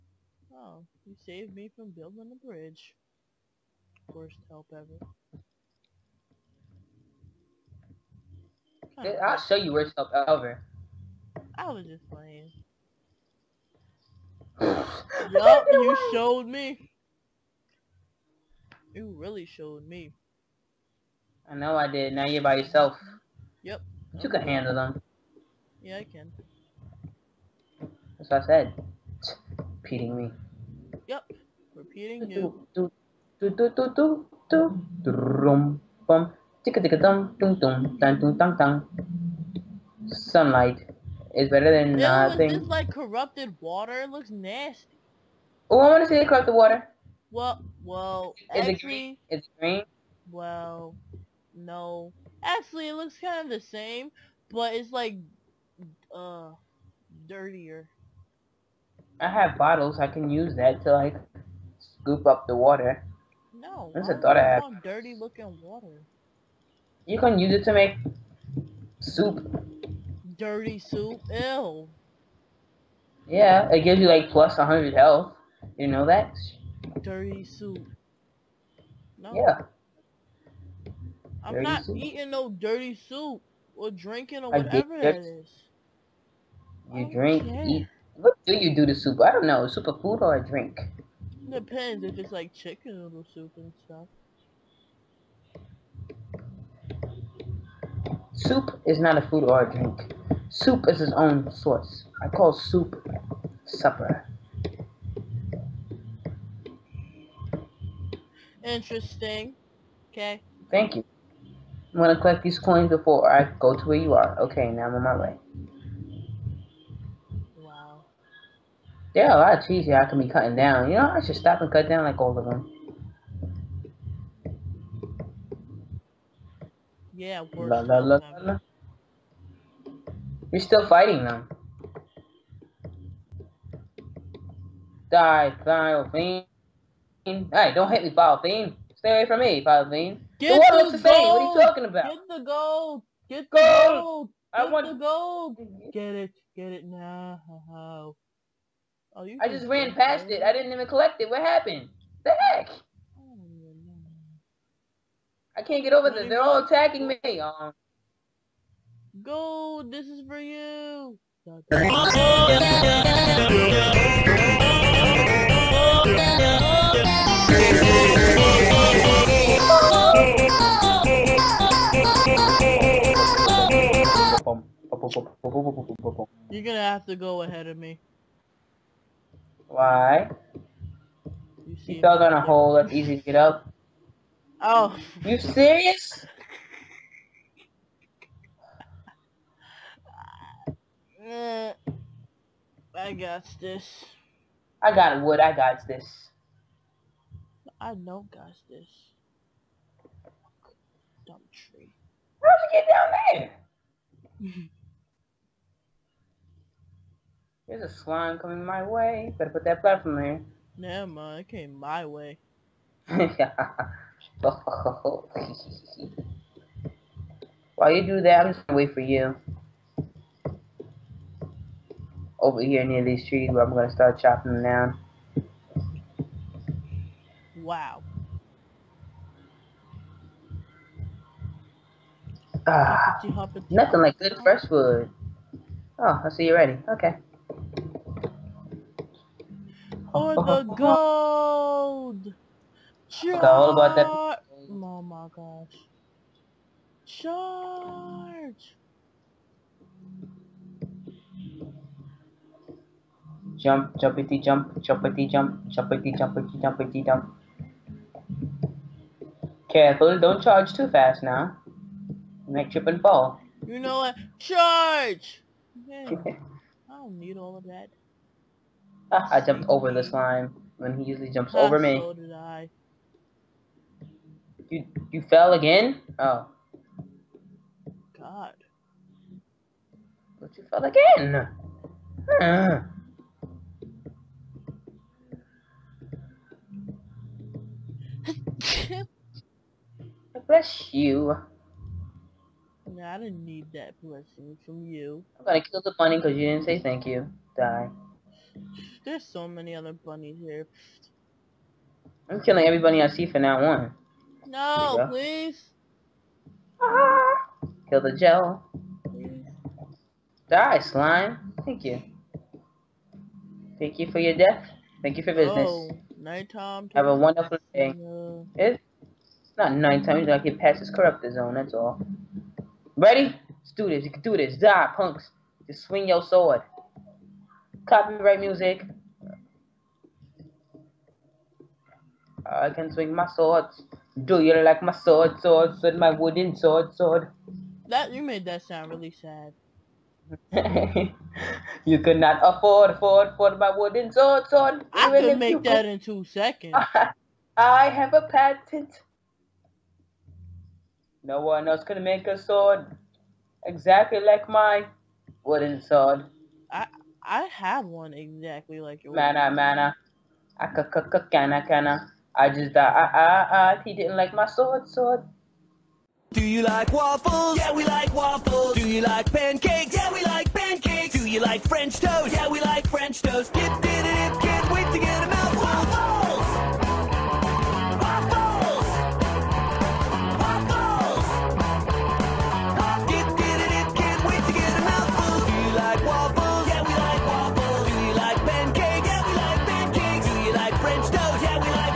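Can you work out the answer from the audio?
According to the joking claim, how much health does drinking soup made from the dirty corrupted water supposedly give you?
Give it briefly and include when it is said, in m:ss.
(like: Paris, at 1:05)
plus 100 health, at 1:14.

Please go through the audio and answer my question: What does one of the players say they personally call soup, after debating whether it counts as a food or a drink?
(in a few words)
supper.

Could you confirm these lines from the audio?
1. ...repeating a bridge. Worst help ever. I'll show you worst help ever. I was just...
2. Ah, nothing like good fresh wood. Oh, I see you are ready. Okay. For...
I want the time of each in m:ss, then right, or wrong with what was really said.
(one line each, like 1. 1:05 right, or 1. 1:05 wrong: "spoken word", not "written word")
1. 0:01 wrong: "building", not "repeating"
2. 3:52 right.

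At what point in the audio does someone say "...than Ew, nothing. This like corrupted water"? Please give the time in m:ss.
0:41.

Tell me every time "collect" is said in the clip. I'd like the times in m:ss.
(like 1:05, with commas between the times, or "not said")
1:52, 2:30.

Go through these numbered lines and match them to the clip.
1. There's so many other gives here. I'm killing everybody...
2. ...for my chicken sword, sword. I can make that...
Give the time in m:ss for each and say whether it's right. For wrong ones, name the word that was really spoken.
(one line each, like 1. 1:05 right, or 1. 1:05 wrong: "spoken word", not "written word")
1. 4:59 wrong: "bunnies", not "gives"
2. 5:43 wrong: "wooden", not "chicken".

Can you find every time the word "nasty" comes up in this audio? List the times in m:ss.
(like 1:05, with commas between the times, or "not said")
0:44.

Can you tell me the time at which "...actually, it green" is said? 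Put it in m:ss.
0:48.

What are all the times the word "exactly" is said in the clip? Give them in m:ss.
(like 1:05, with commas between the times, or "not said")
5:53, 5:58.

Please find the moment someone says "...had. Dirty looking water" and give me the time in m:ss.
1:04.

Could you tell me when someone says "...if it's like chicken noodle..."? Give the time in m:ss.
1:32.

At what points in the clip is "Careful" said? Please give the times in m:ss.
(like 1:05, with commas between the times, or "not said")
4:19.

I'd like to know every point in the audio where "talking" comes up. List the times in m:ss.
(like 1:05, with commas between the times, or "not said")
2:21.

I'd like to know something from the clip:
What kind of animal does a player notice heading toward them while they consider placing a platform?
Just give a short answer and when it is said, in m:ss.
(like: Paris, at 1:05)
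swan, at 3:28.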